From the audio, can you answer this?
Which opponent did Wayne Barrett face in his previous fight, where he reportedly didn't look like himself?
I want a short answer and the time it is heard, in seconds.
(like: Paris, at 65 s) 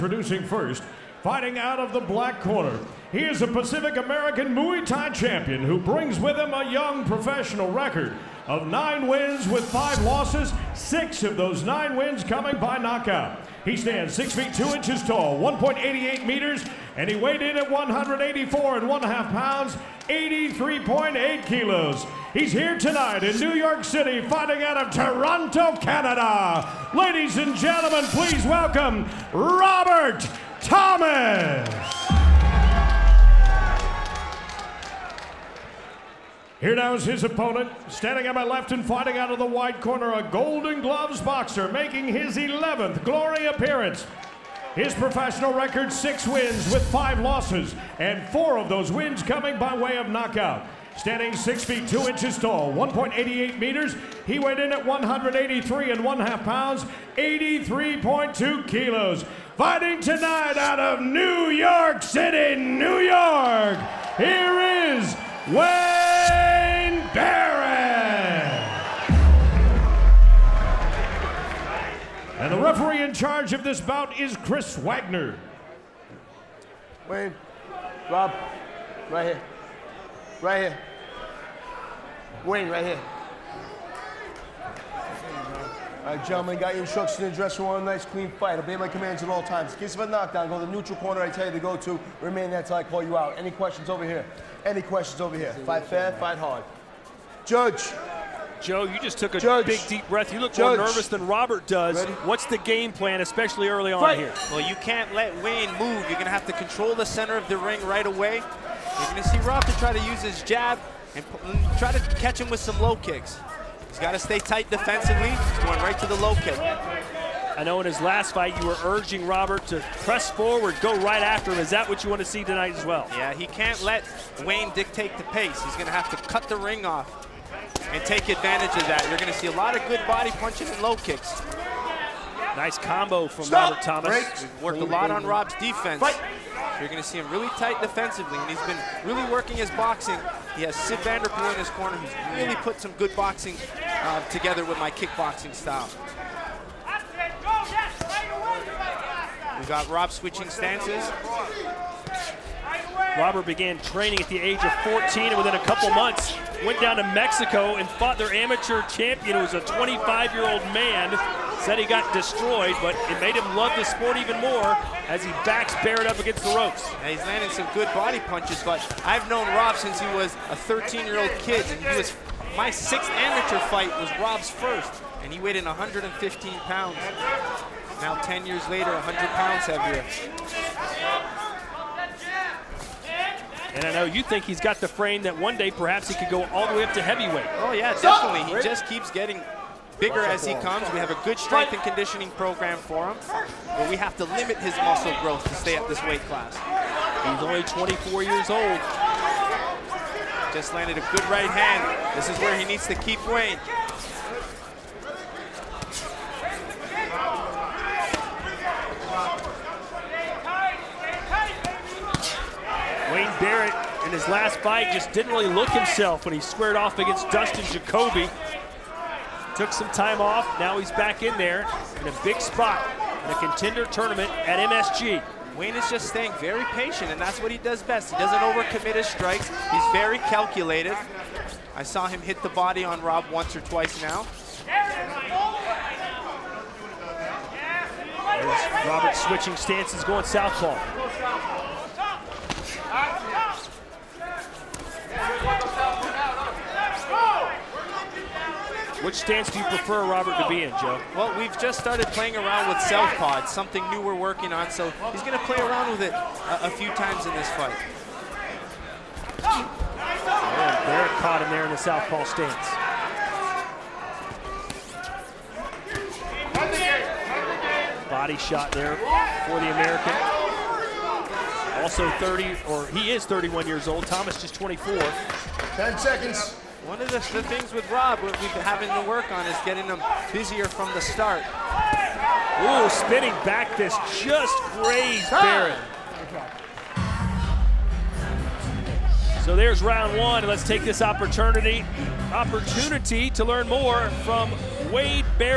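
Dustin Jacoby, at 217 s.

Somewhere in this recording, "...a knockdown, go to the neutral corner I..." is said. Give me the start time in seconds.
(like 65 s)
90 s.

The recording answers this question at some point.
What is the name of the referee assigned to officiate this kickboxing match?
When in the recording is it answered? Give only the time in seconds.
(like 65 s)
74 s.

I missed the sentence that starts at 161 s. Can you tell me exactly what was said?
Said he got destroyed, but it made him love the sport even more as he backs Barrett up against the ropes.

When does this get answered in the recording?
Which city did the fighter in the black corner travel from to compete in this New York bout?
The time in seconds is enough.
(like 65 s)
24 s.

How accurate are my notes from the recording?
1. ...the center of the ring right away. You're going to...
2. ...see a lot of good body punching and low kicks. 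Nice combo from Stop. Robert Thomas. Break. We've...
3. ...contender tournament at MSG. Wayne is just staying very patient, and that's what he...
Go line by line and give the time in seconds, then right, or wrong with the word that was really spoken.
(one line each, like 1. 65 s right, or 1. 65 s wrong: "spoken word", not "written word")
1. 106 s right
2. 129 s right
3. 223 s right.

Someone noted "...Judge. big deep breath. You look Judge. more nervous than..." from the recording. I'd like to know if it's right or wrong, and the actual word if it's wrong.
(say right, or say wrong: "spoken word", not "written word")
right.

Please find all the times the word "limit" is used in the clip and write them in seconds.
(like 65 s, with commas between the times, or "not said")
194 s.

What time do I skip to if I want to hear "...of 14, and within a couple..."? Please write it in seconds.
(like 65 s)
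154 s.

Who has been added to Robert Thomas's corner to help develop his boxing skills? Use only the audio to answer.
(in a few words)
Sid Vanderpool.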